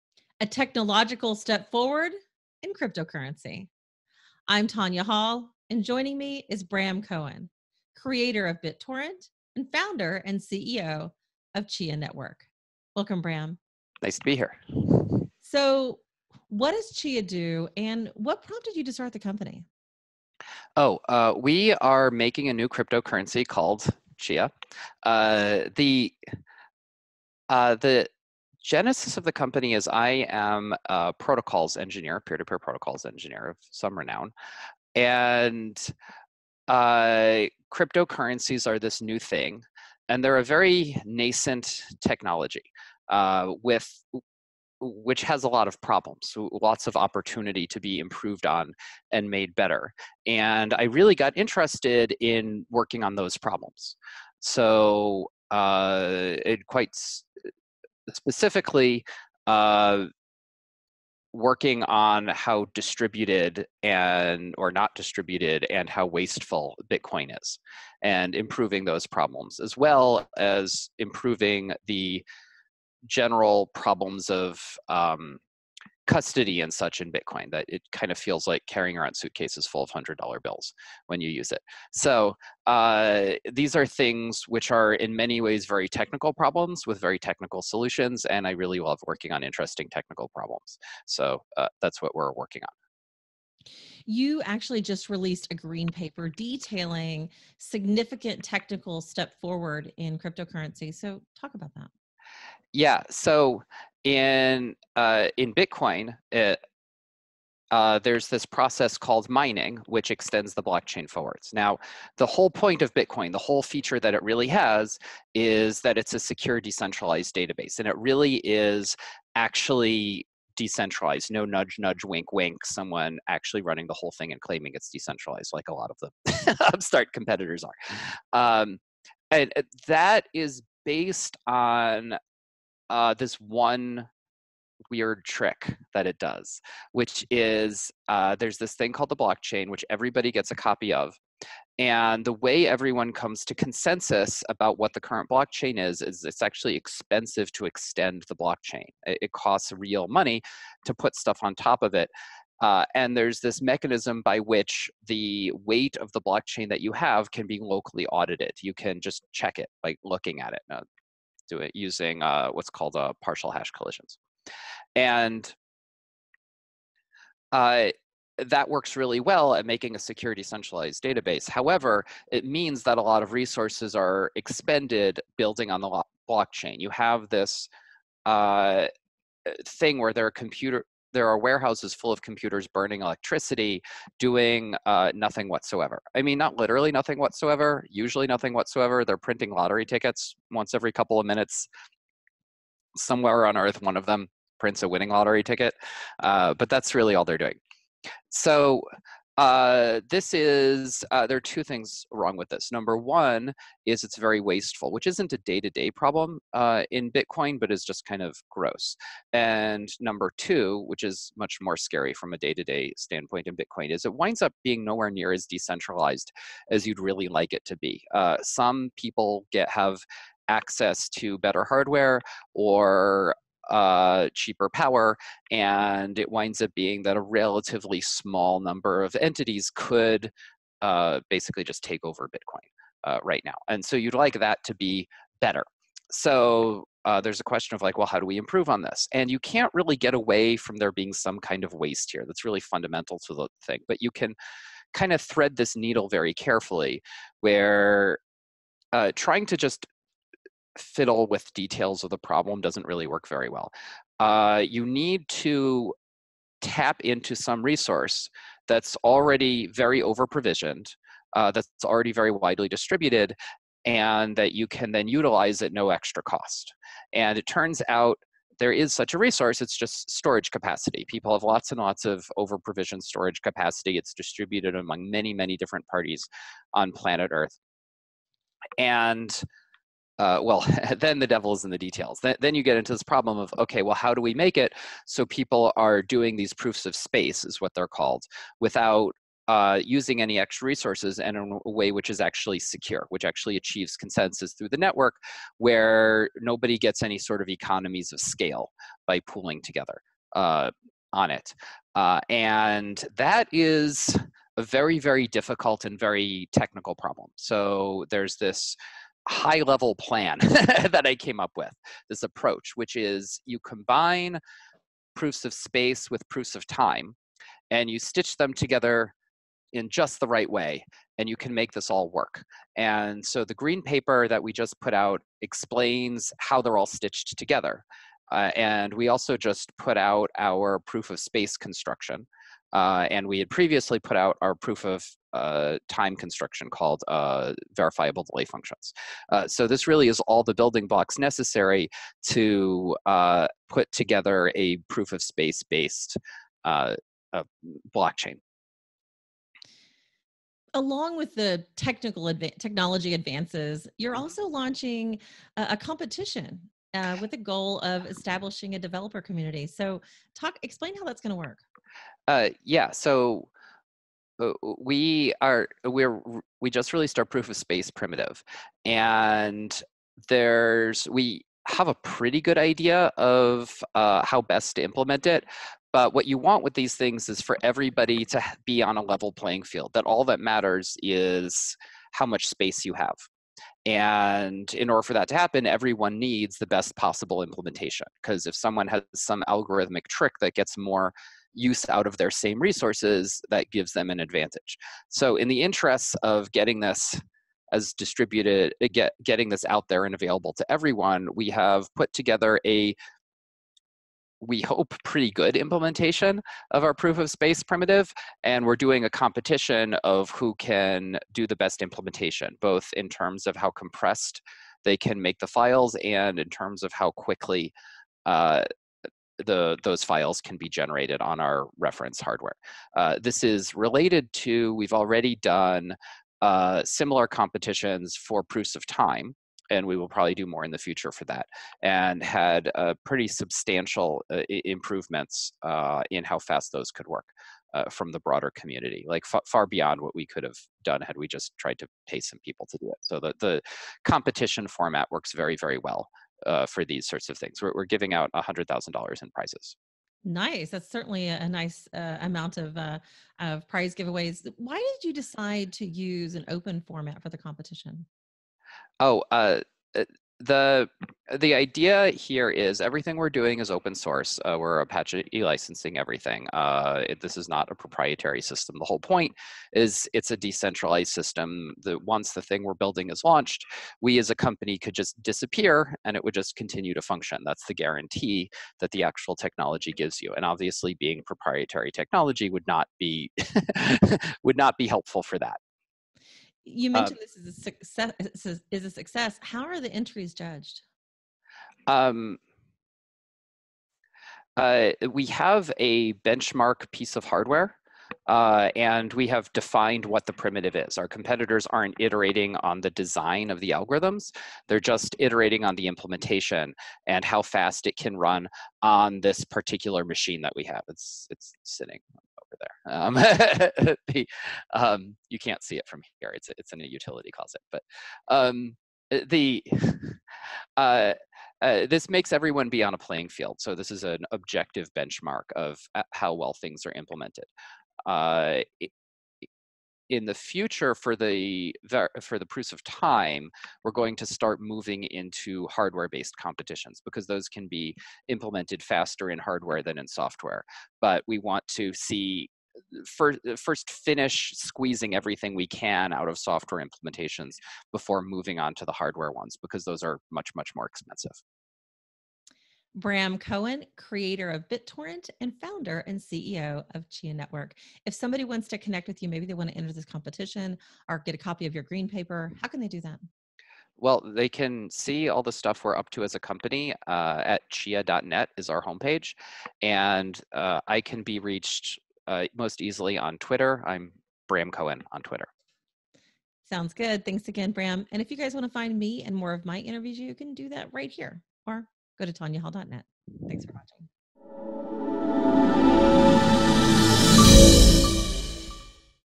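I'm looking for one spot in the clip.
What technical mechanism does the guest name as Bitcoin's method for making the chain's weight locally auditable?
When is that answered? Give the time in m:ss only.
2:43.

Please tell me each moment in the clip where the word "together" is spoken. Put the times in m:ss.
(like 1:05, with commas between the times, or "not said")
4:59, 5:18, 5:27, 5:43, 6:42.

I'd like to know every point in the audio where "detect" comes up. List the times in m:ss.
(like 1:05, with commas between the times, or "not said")
not said.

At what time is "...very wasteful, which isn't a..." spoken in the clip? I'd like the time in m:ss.
3:24.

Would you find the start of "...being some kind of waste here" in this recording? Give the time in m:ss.
4:00.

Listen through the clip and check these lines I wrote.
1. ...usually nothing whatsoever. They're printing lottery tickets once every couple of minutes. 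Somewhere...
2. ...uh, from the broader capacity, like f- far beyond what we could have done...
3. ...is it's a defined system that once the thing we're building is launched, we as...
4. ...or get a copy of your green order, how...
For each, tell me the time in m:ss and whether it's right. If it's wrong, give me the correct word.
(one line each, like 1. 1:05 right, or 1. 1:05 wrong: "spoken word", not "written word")
1. 3:07 right
2. 7:17 wrong: "community", not "capacity"
3. 7:49 wrong: "decentralized", not "defined"
4. 9:21 wrong: "paper", not "order".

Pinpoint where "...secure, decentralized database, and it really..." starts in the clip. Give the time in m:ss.
1:56.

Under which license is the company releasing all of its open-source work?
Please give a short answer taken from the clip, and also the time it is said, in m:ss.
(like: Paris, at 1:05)
Apache, at 7:44.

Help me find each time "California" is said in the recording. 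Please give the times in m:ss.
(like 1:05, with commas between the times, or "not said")
not said.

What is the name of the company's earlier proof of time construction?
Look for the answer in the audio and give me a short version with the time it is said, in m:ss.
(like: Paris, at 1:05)
Verifiable delay functions, at 5:37.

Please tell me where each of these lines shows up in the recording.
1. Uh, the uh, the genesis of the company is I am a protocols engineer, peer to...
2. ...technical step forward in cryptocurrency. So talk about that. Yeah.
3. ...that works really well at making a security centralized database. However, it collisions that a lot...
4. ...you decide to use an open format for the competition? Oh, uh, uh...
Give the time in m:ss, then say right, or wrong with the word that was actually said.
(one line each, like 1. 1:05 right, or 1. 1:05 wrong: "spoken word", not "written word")
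1. 0:25 right
2. 1:38 right
3. 2:48 wrong: "means", not "collisions"
4. 7:35 right.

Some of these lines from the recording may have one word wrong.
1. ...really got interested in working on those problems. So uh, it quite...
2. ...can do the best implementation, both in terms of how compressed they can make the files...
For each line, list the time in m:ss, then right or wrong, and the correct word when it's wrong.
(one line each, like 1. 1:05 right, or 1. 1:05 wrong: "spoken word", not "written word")
1. 0:50 right
2. 6:50 right.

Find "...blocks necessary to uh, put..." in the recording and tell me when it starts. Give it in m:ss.
5:40.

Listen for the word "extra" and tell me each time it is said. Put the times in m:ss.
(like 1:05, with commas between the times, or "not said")
4:25, 4:50.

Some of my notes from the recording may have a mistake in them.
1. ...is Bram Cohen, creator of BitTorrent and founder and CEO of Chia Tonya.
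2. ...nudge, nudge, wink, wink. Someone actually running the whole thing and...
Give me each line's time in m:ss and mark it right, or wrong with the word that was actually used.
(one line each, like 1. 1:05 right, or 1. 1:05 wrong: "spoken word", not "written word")
1. 0:06 wrong: "Network", not "Tonya"
2. 2:01 right.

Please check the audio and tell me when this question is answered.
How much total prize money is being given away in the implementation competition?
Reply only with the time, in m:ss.
7:28.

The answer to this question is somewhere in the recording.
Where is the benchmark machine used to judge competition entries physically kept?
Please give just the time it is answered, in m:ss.
8:36.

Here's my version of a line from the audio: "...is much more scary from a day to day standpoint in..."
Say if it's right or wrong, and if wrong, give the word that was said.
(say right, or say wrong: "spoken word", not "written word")
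right.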